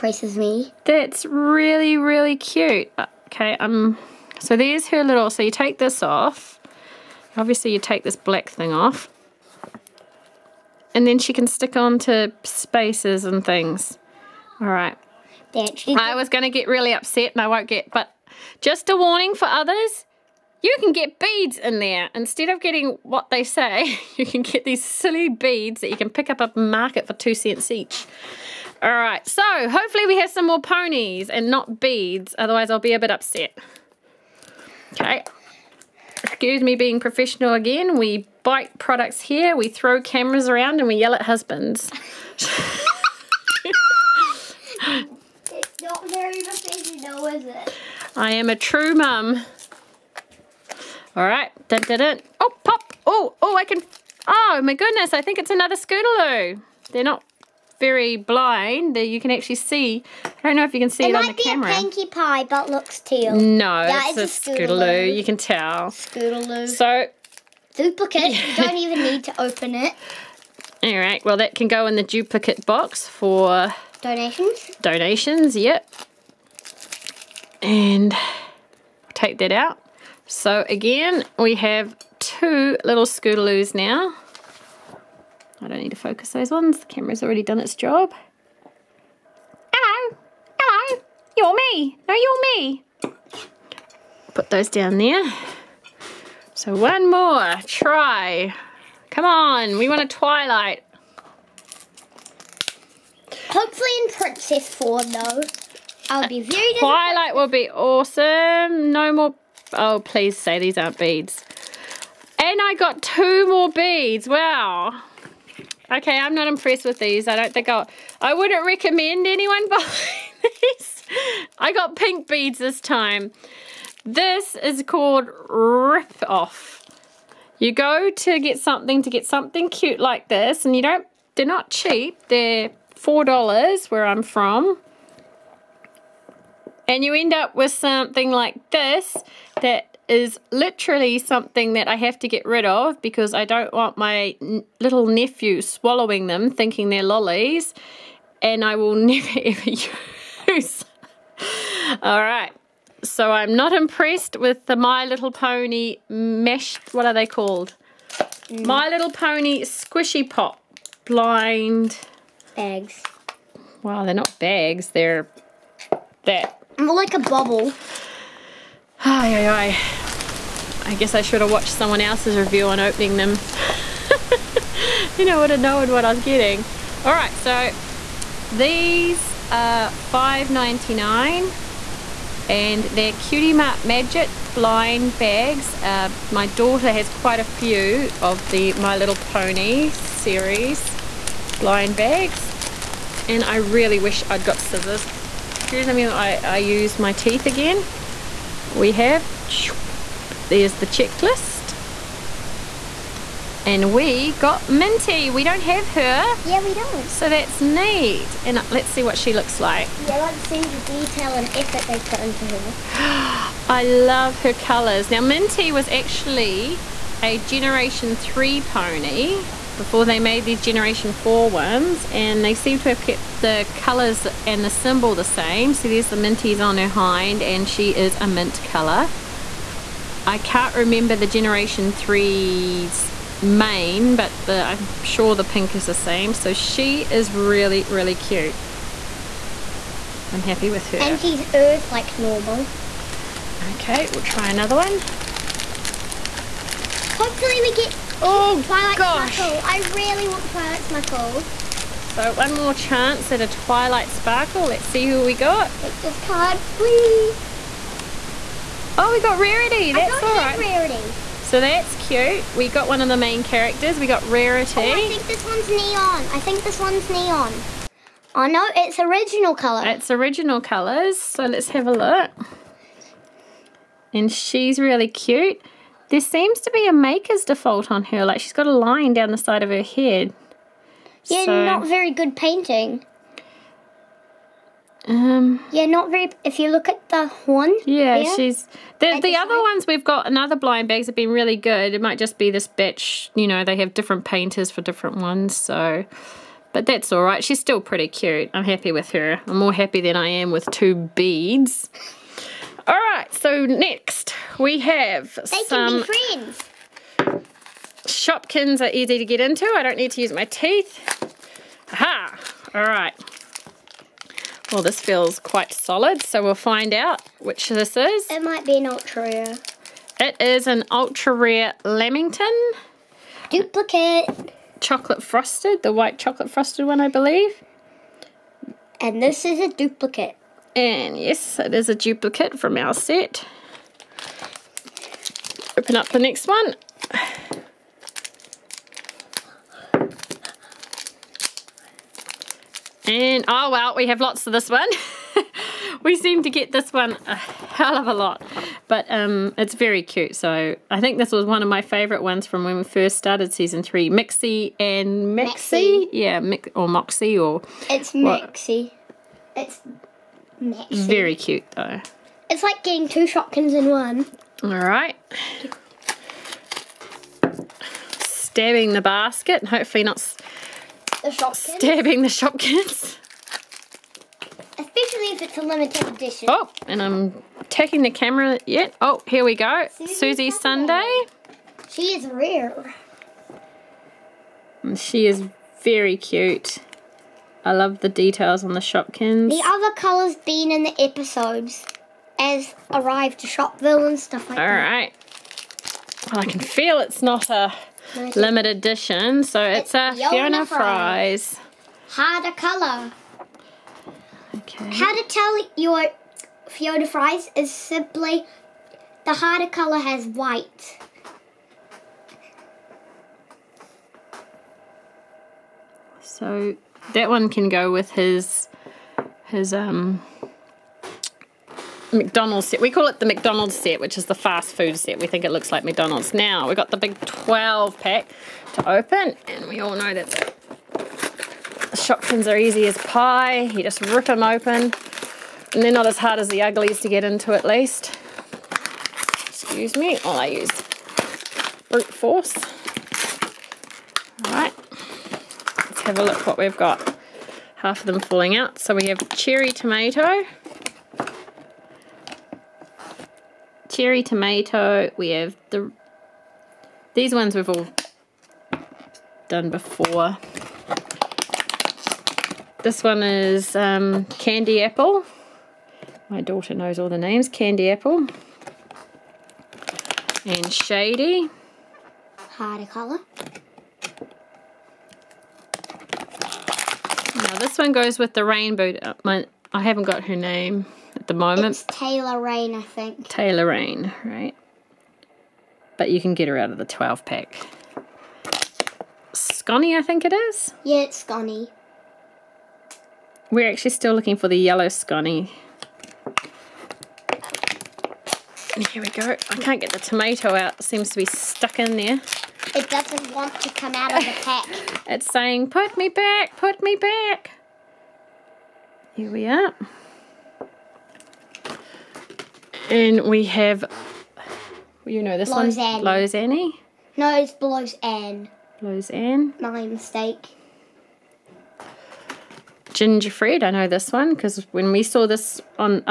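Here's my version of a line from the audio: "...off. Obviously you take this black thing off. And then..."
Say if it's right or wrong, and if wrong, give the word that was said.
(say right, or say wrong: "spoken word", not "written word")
right.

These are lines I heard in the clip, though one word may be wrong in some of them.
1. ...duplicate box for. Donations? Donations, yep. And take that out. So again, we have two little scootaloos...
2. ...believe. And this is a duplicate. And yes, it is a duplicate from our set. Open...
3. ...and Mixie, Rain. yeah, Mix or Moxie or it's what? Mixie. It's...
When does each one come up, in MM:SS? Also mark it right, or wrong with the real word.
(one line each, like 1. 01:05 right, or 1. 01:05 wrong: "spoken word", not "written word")
1. 01:12 right
2. 05:27 right
3. 05:54 wrong: "Mixie", not "Rain".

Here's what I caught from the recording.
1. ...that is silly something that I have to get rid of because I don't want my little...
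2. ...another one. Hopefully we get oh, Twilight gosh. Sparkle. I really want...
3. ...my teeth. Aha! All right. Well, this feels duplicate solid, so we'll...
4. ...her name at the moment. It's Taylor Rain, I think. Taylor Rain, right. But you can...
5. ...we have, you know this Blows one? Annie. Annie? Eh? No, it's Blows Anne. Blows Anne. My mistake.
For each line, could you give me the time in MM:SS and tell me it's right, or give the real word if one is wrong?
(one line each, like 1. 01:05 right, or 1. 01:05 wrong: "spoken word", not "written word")
1. 02:19 wrong: "literally", not "silly"
2. 04:04 right
3. 05:10 wrong: "quite", not "duplicate"
4. 08:00 right
5. 08:33 right.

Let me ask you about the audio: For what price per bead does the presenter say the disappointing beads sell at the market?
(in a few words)
2 cents each.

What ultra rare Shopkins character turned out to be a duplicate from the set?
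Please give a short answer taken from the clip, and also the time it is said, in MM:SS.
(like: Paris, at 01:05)
Lamington, at 05:21.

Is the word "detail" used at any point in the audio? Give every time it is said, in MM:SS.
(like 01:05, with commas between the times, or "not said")
03:30, 06:28.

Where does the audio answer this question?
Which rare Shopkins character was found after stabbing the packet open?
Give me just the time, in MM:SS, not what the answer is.
06:20.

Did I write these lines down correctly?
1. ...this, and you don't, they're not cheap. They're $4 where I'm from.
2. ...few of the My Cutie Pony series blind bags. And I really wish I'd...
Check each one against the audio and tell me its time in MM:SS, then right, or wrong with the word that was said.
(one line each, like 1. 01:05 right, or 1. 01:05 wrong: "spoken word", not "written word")
1. 02:10 right
2. 03:07 wrong: "Little", not "Cutie".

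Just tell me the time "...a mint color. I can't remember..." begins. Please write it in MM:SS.
03:48.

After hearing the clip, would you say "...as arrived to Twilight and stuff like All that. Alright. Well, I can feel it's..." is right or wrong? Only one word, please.
wrong.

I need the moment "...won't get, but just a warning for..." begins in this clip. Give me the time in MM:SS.
00:17.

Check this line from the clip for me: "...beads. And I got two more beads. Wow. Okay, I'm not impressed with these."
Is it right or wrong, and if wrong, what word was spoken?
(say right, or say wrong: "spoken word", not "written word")
right.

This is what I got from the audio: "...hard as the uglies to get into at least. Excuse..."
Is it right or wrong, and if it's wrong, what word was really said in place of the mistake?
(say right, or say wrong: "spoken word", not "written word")
right.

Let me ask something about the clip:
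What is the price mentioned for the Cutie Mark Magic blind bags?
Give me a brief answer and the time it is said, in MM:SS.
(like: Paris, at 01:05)
5.99, at 02:59.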